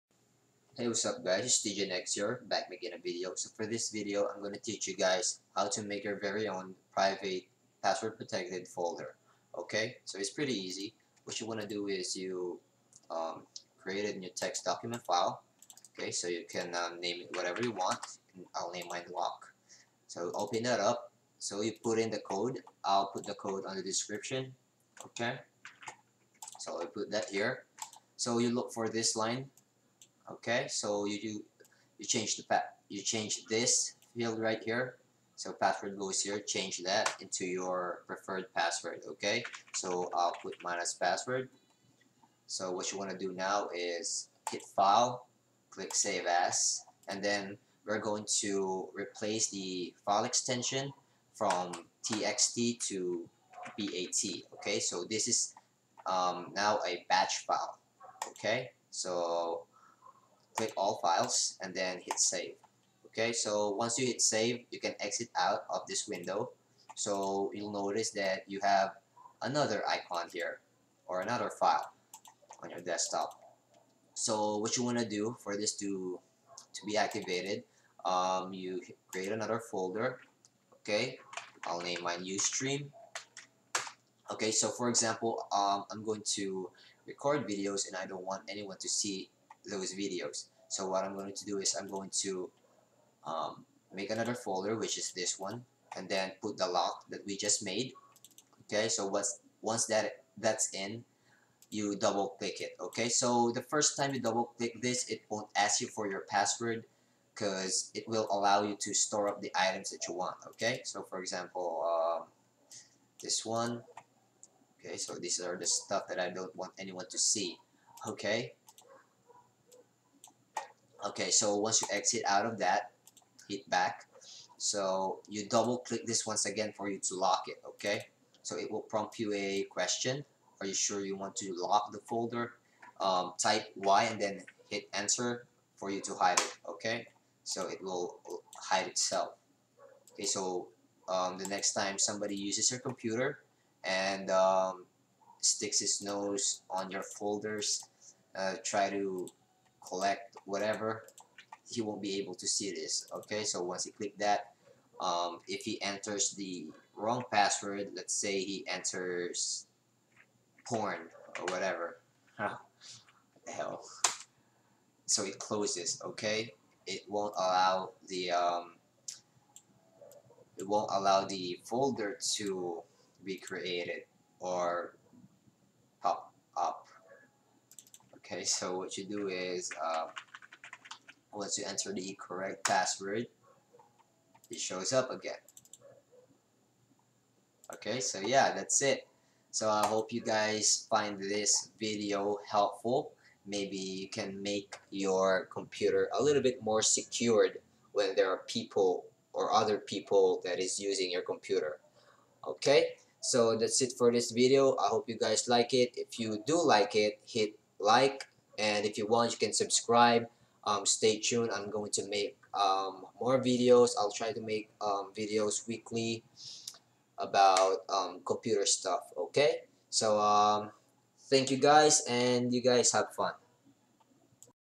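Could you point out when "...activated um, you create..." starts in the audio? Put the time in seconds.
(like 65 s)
76 s.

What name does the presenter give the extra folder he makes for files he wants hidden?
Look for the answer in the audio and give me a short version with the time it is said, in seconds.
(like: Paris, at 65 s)
Ustream, at 82 s.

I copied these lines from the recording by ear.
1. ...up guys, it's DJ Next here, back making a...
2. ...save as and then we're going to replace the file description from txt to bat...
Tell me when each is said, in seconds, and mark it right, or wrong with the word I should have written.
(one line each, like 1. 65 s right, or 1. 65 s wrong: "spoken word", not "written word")
1. 1 s right
2. 45 s wrong: "extension", not "description".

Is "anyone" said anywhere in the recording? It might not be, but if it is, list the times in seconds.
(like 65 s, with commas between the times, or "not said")
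88 s, 116 s.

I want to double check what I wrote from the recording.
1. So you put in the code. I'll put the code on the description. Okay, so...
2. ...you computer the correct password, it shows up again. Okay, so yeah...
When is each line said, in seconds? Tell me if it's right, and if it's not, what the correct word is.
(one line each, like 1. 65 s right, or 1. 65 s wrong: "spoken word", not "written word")
1. 21 s right
2. 181 s wrong: "enter", not "computer".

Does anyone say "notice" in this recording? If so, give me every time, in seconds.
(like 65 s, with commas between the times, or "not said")
67 s.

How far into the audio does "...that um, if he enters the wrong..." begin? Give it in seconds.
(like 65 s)
154 s.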